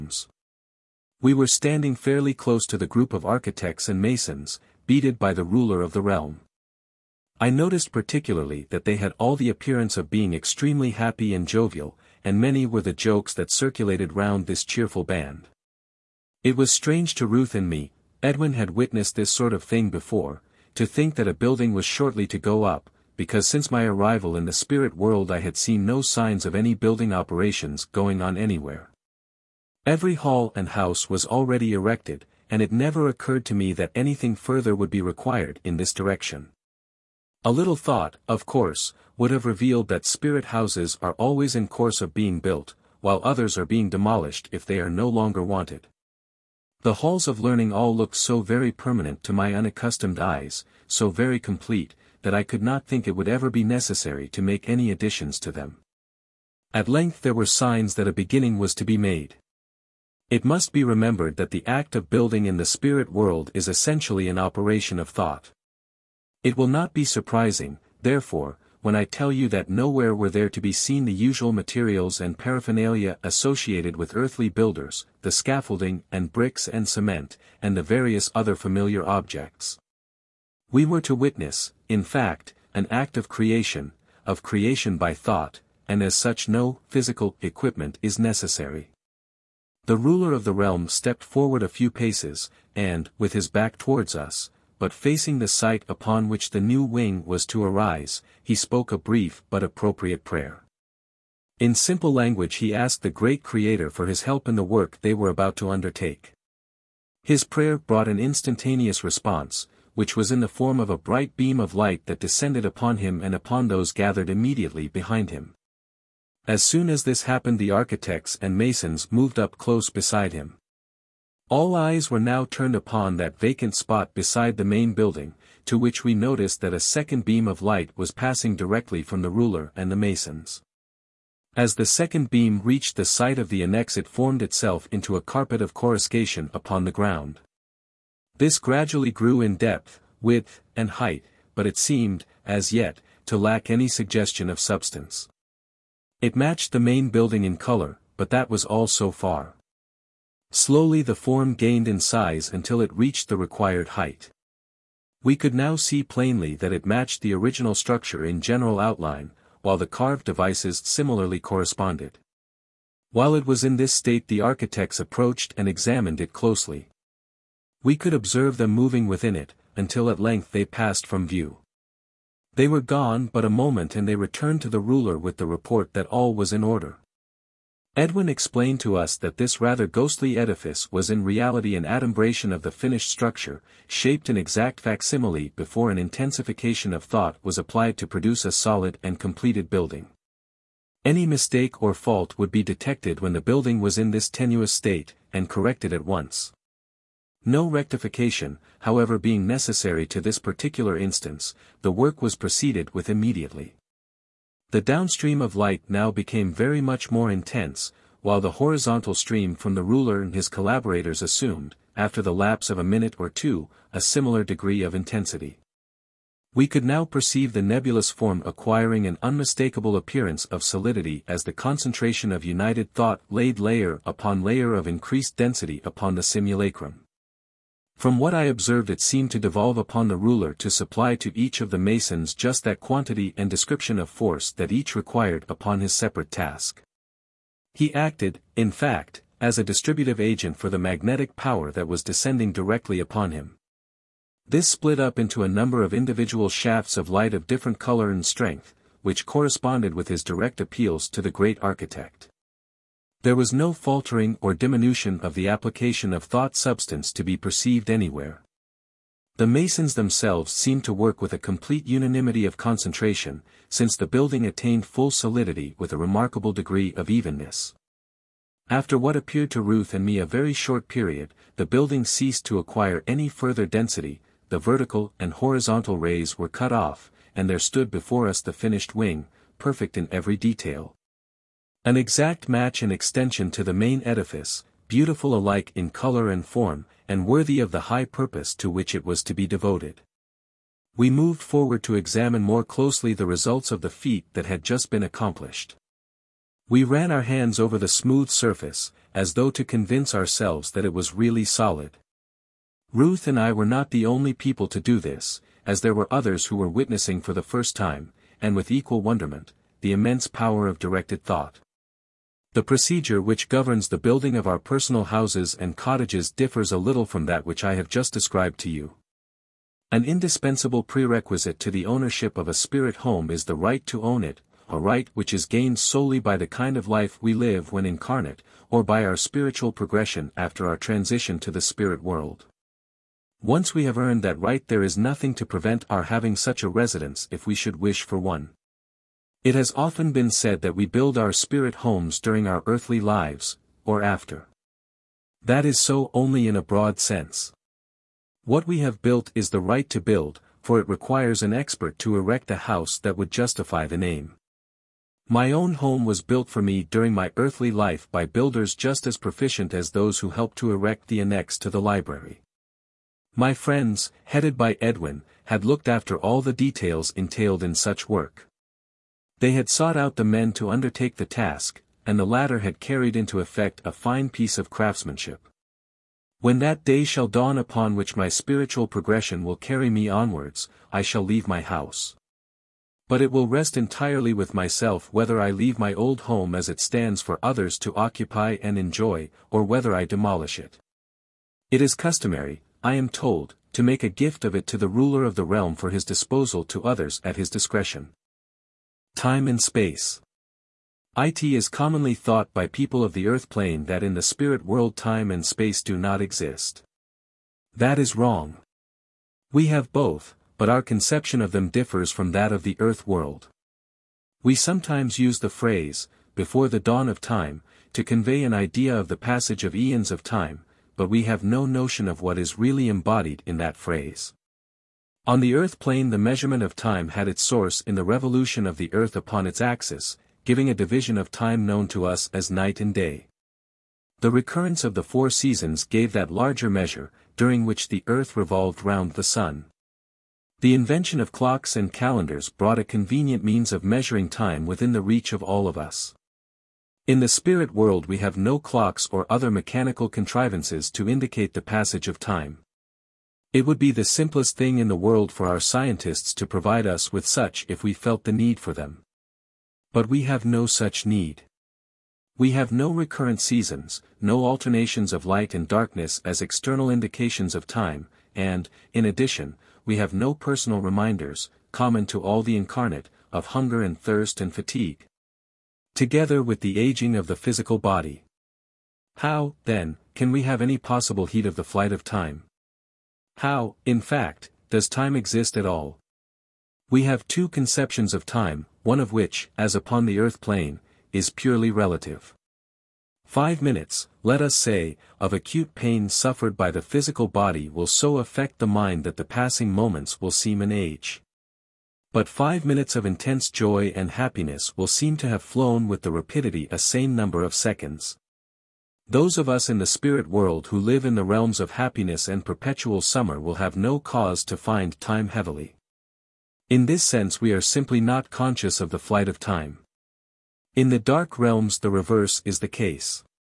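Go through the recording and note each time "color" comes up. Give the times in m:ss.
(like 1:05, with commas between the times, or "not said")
2:27, 4:07, 4:45.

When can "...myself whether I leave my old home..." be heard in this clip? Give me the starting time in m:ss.
6:24.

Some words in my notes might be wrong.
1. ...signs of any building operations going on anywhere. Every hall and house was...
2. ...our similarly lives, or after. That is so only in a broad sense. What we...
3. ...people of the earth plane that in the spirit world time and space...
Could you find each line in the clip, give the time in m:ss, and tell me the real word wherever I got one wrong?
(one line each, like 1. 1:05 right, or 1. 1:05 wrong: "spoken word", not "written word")
1. 0:26 right
2. 5:42 wrong: "earthly", not "similarly"
3. 6:42 right.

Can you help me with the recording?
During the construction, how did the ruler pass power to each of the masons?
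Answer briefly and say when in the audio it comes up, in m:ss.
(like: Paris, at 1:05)
As a distributive agent, at 3:59.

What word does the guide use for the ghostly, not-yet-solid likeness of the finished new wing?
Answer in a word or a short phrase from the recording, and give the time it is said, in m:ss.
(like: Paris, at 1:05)
Adumbration, at 3:01.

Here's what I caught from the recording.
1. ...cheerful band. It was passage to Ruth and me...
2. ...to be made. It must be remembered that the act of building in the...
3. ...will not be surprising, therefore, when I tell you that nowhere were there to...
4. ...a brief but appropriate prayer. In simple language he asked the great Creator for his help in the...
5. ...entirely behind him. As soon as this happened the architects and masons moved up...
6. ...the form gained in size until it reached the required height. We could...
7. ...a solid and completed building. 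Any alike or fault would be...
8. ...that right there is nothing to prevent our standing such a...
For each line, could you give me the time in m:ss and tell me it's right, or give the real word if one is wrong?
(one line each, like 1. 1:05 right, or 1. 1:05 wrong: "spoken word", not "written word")
1. 0:14 wrong: "strange", not "passage"
2. 0:58 right
3. 1:06 right
4. 1:38 right
5. 1:54 wrong: "immediately", not "entirely"
6. 2:31 right
7. 3:08 wrong: "mistake", not "alike"
8. 5:34 wrong: "having", not "standing".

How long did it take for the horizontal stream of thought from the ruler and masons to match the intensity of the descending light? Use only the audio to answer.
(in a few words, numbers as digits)
A minute or two.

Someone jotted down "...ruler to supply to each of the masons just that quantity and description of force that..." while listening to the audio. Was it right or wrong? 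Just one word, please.
right.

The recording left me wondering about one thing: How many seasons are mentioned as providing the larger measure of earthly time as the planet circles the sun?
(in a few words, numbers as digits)
4.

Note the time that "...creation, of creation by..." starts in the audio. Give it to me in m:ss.
1:23.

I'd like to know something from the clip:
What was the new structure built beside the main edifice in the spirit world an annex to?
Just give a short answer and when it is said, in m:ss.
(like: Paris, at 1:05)
The library, at 6:01.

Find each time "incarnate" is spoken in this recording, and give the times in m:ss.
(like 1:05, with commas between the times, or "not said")
5:27, 7:52.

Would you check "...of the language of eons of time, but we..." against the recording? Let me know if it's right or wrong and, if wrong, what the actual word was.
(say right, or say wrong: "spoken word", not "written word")
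wrong: "passage", not "language".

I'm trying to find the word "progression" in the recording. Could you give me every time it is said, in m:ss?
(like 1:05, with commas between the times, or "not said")
5:29, 6:18.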